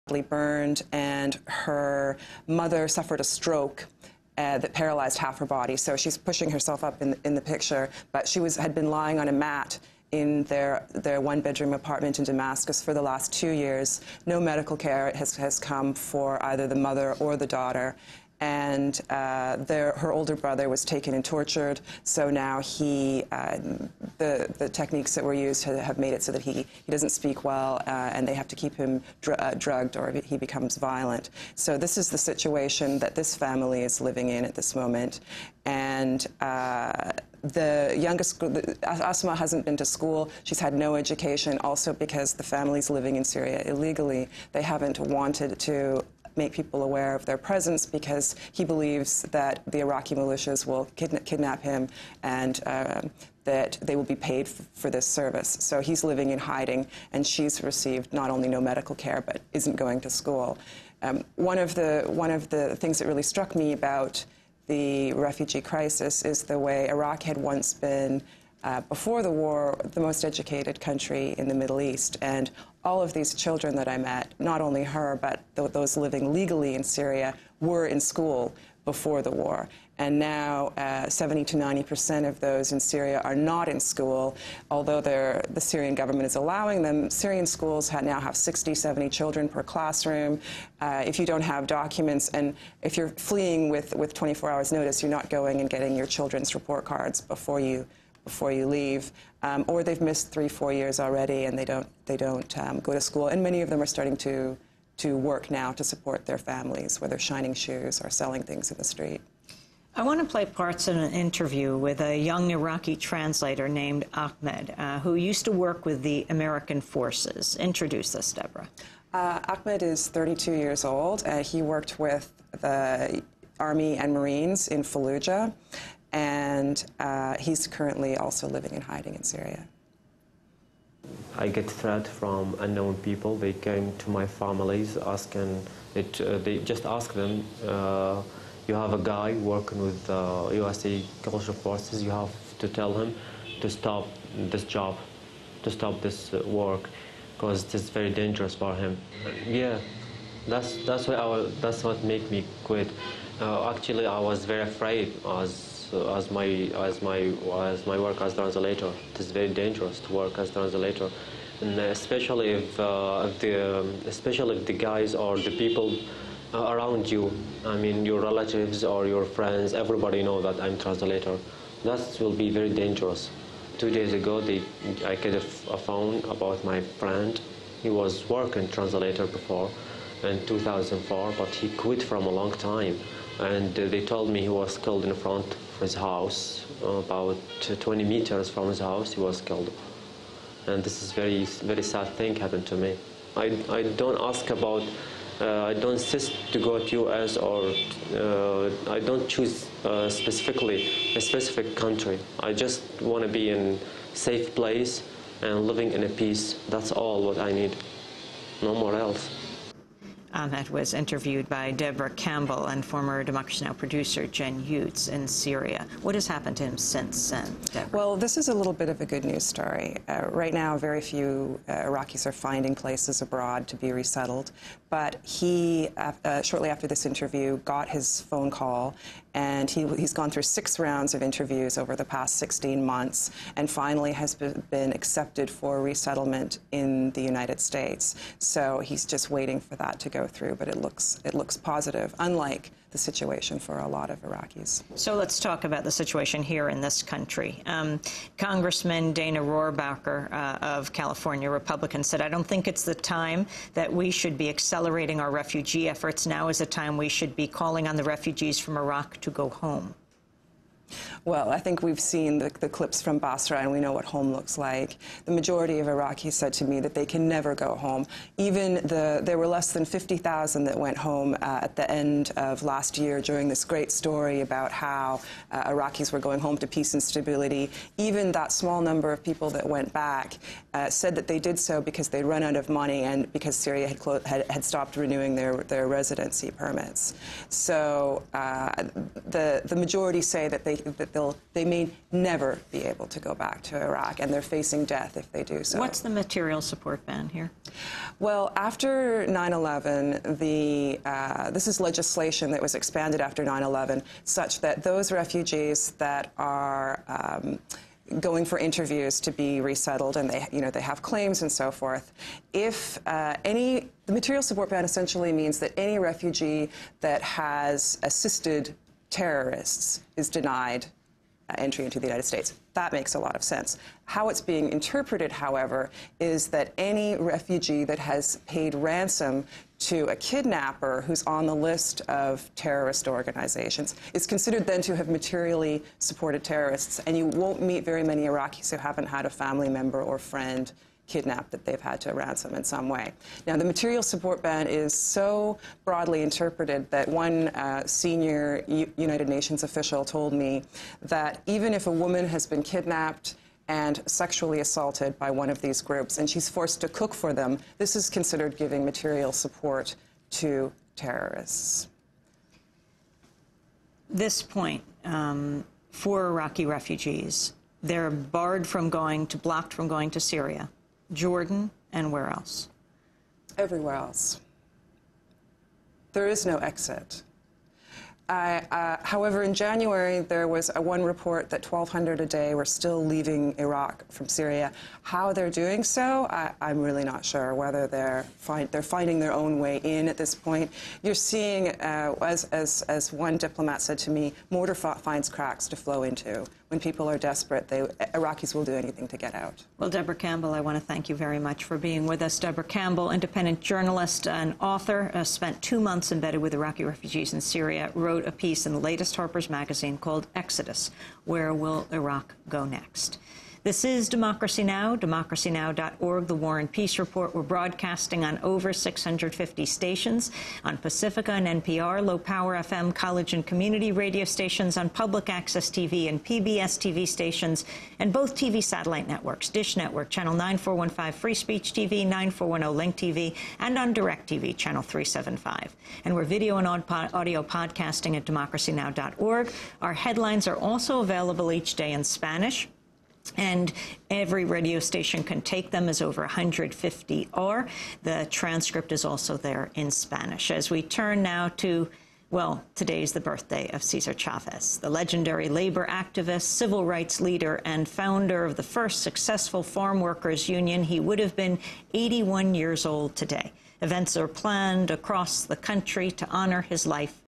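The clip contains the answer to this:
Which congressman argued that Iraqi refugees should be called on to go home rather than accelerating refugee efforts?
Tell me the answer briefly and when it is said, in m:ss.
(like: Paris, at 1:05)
Dana Rohrabacher, at 4:09.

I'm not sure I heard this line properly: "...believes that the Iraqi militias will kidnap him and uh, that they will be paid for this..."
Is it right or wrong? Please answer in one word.
right.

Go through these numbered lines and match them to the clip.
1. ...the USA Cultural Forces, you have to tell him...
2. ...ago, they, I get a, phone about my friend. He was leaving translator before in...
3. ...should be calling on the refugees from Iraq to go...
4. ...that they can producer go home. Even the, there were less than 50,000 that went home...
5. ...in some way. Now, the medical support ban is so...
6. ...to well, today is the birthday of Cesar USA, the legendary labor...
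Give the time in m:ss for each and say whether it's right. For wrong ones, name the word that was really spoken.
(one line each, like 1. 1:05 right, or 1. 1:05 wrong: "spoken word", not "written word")
1. 2:20 right
2. 2:54 wrong: "working", not "leaving"
3. 4:17 right
4. 4:26 wrong: "never", not "producer"
5. 5:42 wrong: "material", not "medical"
6. 7:31 wrong: "Chavez", not "USA".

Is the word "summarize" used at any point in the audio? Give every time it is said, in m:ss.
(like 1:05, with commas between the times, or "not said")
not said.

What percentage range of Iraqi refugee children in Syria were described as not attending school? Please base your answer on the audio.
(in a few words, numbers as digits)
70 to 90 percent.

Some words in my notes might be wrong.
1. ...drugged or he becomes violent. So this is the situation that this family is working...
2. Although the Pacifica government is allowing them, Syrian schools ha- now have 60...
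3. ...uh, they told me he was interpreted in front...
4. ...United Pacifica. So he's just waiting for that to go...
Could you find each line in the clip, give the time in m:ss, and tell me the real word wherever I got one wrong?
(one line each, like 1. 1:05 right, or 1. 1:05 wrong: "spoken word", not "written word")
1. 0:29 wrong: "living", not "working"
2. 1:24 wrong: "Syrian", not "Pacifica"
3. 3:03 wrong: "killed", not "interpreted"
4. 3:57 wrong: "States", not "Pacifica".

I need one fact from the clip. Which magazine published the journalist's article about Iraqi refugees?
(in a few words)
Harper's Magazine.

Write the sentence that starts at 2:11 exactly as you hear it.
I get threat from unknown people.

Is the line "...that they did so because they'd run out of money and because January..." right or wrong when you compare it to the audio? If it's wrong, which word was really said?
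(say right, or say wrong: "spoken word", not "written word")
wrong: "Syria", not "January".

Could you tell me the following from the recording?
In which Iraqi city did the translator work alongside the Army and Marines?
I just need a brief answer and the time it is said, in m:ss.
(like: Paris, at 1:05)
Fallujah, at 2:04.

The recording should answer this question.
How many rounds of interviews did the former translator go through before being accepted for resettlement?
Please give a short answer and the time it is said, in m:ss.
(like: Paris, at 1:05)
6, at 3:50.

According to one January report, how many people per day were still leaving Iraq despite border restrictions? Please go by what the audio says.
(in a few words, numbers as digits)
1,200.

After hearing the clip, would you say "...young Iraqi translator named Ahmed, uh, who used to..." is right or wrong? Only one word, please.
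right.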